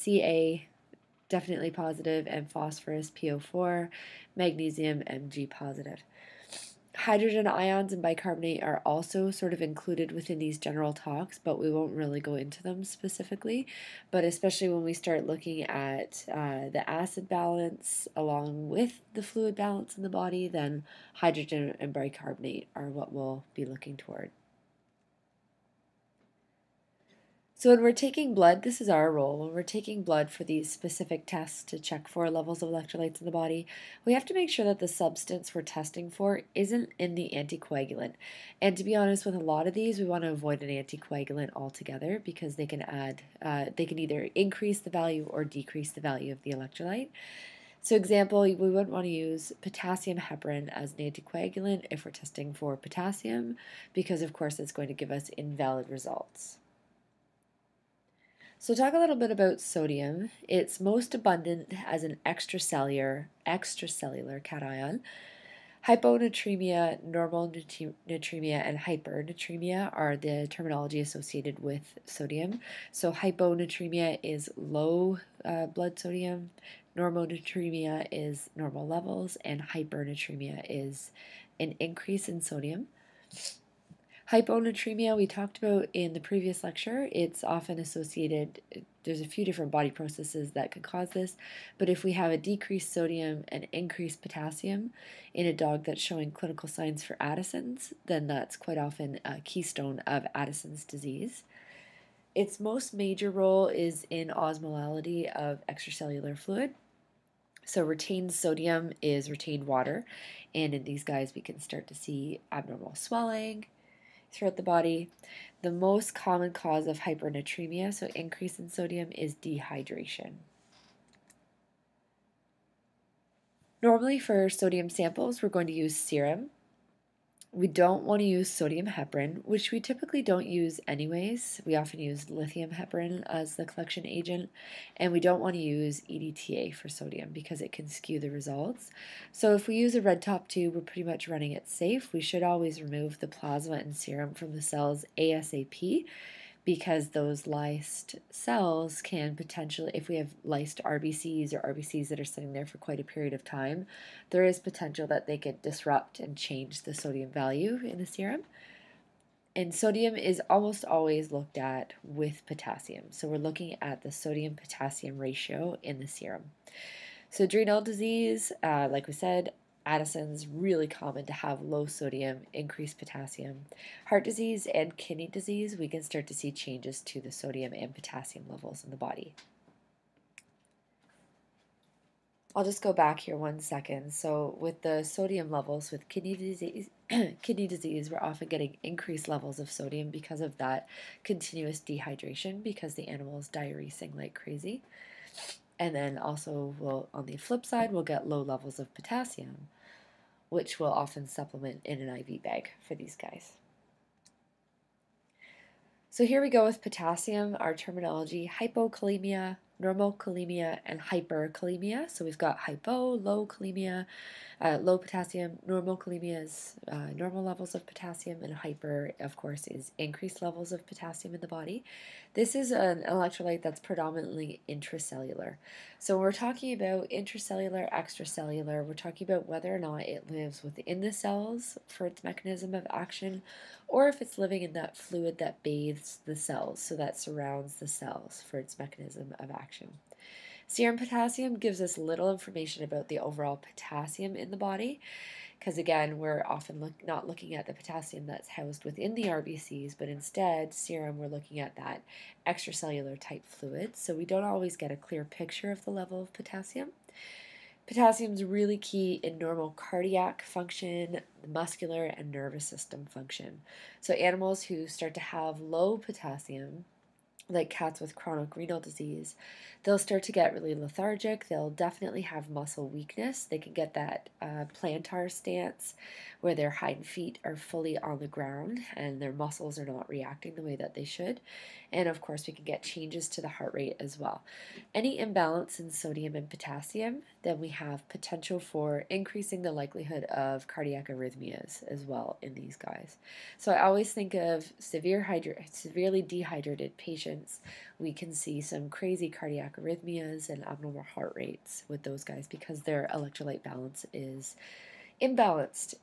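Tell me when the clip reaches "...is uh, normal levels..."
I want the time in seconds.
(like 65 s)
216 s.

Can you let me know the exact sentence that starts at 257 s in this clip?
Potassium is really key in normal cardiac function, muscular, and nervous system function.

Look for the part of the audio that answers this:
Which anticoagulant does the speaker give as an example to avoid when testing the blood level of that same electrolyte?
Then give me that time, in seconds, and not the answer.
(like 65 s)
49 s.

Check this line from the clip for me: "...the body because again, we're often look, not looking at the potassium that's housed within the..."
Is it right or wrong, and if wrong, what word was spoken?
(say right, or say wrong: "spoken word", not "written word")
right.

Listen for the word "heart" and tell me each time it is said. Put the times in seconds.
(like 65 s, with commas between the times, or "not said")
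174 s, 283 s, 301 s.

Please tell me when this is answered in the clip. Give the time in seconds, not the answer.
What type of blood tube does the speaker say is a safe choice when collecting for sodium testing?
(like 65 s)
140 s.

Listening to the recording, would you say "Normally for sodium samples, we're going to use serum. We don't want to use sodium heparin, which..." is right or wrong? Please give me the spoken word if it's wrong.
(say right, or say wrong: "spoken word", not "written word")
right.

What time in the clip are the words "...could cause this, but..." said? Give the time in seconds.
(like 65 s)
90 s.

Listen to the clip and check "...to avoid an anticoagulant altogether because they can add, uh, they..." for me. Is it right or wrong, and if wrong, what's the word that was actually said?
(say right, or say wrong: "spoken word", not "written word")
right.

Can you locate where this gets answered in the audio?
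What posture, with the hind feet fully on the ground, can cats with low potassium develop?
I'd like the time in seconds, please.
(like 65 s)
274 s.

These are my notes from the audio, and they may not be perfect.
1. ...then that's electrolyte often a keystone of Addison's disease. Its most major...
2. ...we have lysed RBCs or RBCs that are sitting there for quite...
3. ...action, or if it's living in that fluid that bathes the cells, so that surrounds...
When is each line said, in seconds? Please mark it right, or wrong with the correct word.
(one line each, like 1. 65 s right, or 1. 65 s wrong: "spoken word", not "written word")
1. 98 s wrong: "quite", not "electrolyte"
2. 150 s right
3. 232 s right.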